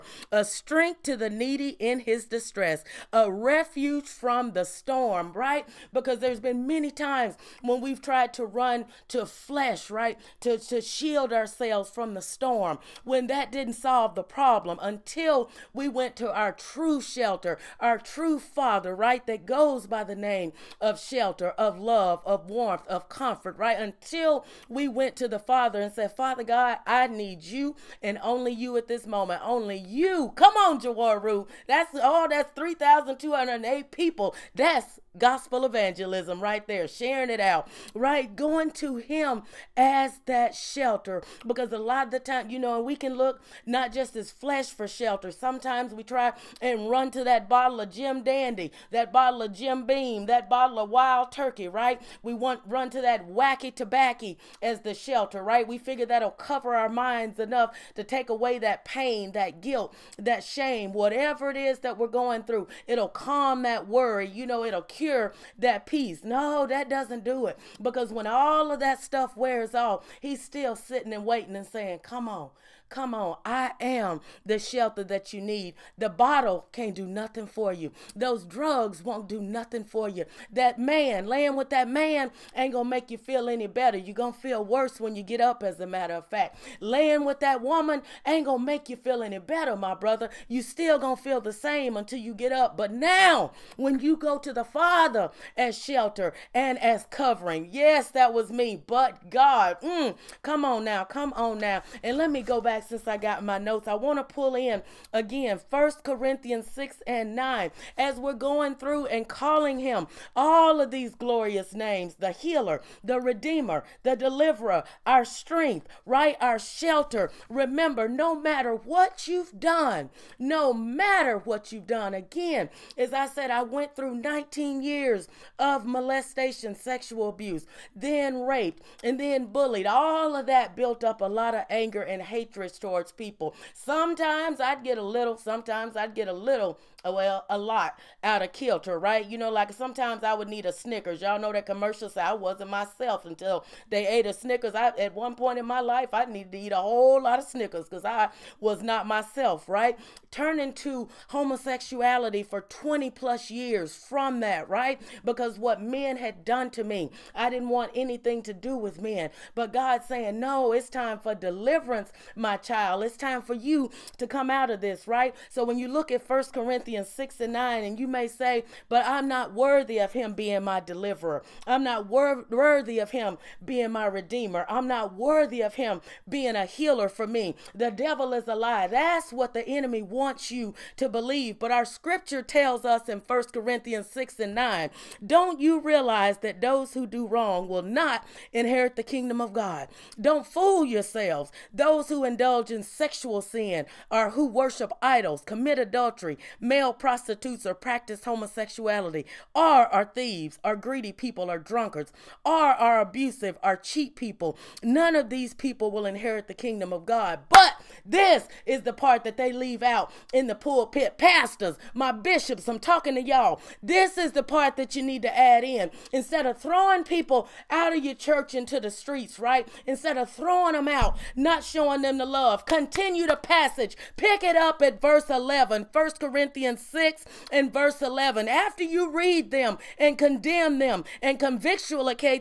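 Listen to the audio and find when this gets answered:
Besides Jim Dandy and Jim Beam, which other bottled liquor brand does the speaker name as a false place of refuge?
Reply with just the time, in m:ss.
0:50.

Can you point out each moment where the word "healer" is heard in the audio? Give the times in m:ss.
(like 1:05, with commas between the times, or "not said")
1:52, 2:56.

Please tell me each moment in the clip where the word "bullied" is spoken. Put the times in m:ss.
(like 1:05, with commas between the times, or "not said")
2:09.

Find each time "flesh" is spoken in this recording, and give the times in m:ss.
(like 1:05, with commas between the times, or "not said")
0:09, 0:44.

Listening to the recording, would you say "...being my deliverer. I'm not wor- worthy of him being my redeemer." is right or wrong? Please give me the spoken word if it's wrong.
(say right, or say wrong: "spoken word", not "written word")
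right.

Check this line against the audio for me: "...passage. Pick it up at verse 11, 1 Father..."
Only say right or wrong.
wrong.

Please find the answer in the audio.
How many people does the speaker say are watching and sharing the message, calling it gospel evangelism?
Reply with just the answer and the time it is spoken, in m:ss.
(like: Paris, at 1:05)
3,208, at 0:32.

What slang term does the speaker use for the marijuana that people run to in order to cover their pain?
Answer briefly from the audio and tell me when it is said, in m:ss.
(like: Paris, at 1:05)
wacky tobacco, at 0:53.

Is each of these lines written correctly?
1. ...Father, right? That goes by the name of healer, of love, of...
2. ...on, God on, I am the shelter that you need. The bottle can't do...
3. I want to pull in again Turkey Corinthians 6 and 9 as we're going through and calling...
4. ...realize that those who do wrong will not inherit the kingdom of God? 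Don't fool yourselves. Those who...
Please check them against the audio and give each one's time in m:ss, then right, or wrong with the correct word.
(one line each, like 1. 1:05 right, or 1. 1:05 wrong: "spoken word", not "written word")
1. 0:18 wrong: "shelter", not "healer"
2. 1:12 wrong: "Come", not "God"
3. 1:43 wrong: "First", not "Turkey"
4. 3:05 right.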